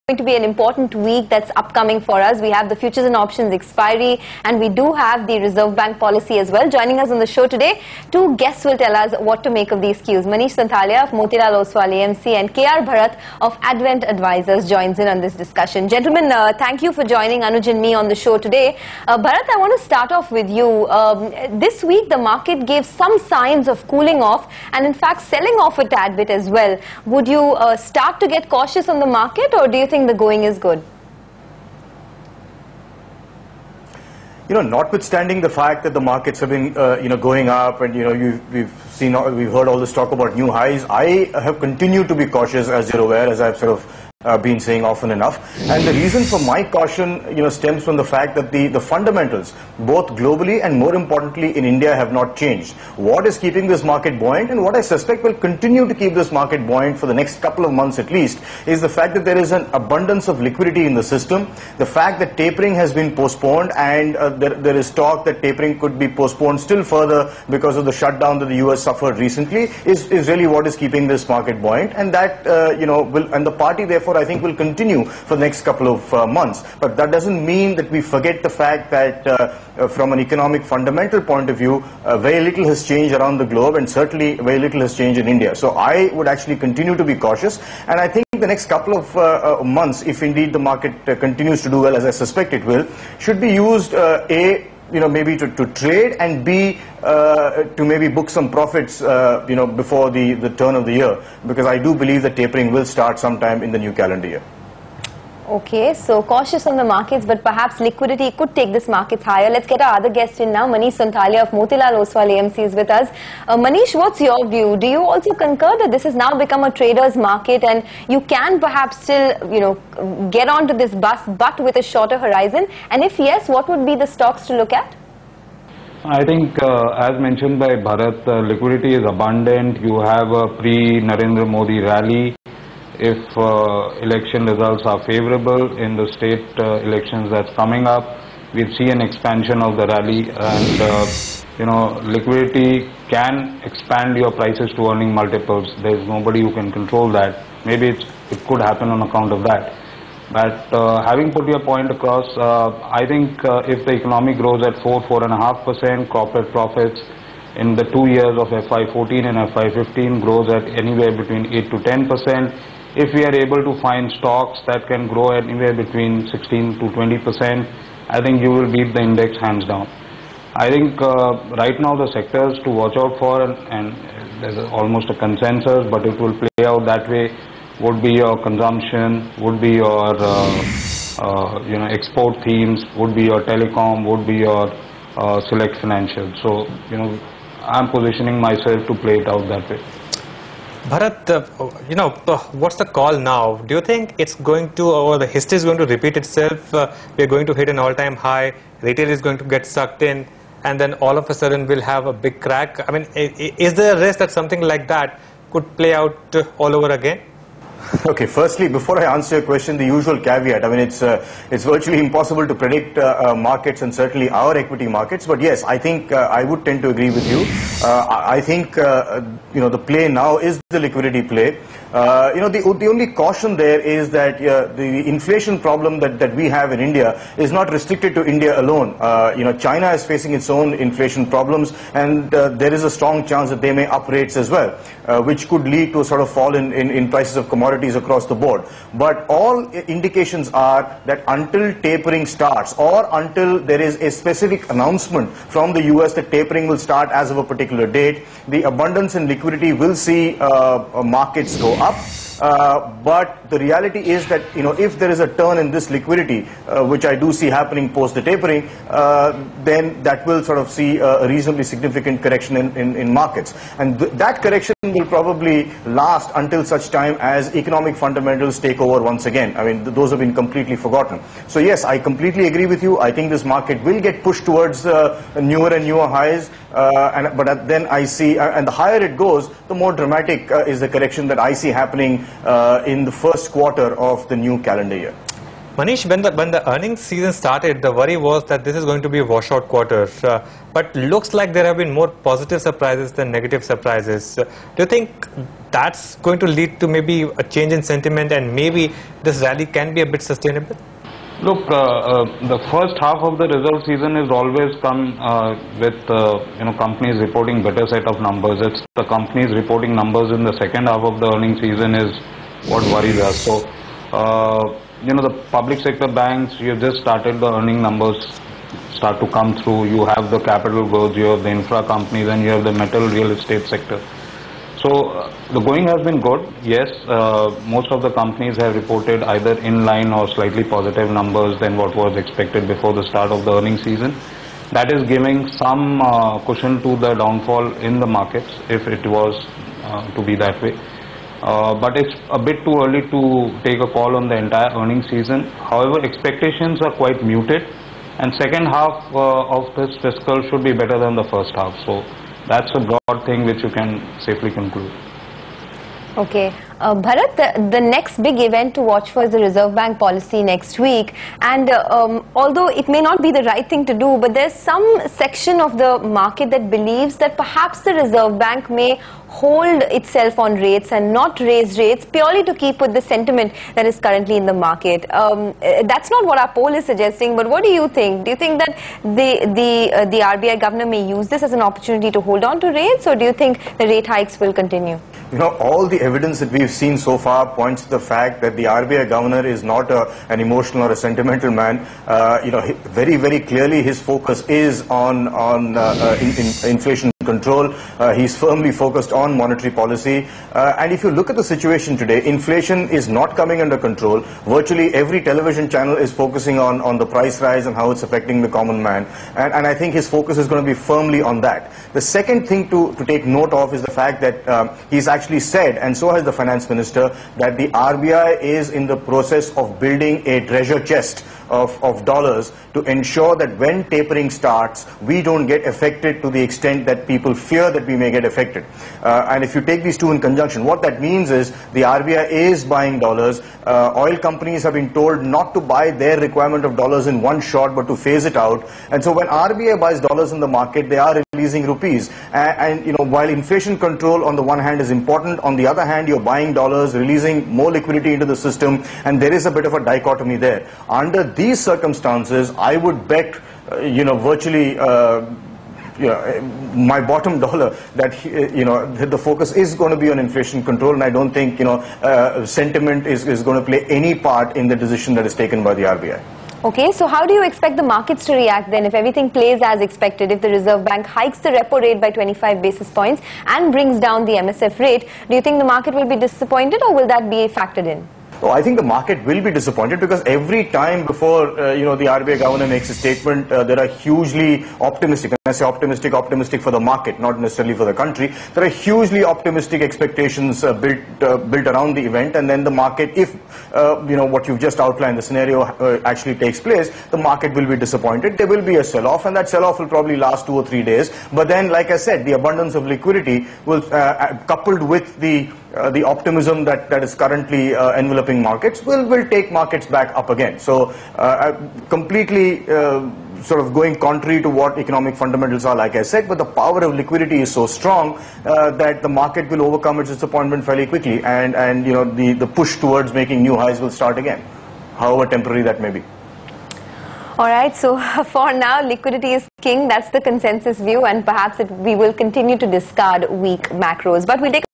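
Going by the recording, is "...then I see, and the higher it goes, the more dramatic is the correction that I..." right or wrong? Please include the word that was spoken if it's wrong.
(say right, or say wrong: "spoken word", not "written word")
right.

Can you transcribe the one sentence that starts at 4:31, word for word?
So yes, I completely agree with you.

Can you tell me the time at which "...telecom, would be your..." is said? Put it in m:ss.
3:03.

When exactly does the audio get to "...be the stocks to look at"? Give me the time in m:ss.
2:03.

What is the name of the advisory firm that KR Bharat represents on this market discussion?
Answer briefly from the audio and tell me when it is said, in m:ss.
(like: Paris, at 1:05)
Advent Advisors, at 0:13.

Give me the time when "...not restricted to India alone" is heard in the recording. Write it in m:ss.
3:47.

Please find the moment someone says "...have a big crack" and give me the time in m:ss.
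3:21.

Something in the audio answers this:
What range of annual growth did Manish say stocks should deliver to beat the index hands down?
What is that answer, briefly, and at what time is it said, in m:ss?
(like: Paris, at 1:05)
16 to 20 percent, at 2:46.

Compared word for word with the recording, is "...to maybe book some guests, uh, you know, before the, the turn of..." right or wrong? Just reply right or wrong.
wrong.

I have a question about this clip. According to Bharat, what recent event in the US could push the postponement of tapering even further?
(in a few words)
the shutdown.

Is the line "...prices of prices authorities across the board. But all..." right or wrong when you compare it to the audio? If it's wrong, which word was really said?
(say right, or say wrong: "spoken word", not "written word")
wrong: "commodities", not "prices".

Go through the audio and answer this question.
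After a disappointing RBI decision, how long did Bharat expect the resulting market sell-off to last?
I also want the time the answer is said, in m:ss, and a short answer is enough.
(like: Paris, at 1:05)
2 or 3 days, at 8:20.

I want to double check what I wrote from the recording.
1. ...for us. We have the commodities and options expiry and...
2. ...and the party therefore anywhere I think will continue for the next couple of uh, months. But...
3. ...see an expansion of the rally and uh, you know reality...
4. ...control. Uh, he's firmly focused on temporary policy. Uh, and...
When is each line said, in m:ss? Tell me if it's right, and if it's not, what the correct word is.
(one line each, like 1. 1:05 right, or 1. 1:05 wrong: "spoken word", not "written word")
1. 0:02 wrong: "futures", not "commodities"
2. 1:13 wrong: "therefore", not "anywhere"
3. 2:18 wrong: "liquidity", not "reality"
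4. 6:37 wrong: "monetary", not "temporary".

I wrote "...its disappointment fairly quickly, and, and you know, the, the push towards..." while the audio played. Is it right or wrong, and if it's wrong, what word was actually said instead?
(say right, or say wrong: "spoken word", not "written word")
right.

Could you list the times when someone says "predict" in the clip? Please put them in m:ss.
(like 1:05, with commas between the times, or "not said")
3:32.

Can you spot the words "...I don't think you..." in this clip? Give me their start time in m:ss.
7:41.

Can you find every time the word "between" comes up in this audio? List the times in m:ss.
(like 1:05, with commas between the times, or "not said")
2:41, 2:45.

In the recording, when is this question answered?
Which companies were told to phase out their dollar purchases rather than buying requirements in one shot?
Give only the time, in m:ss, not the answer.
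7:13.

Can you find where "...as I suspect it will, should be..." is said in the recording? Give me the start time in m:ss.
1:31.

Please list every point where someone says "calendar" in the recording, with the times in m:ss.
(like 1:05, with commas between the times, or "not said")
1:43, 4:44.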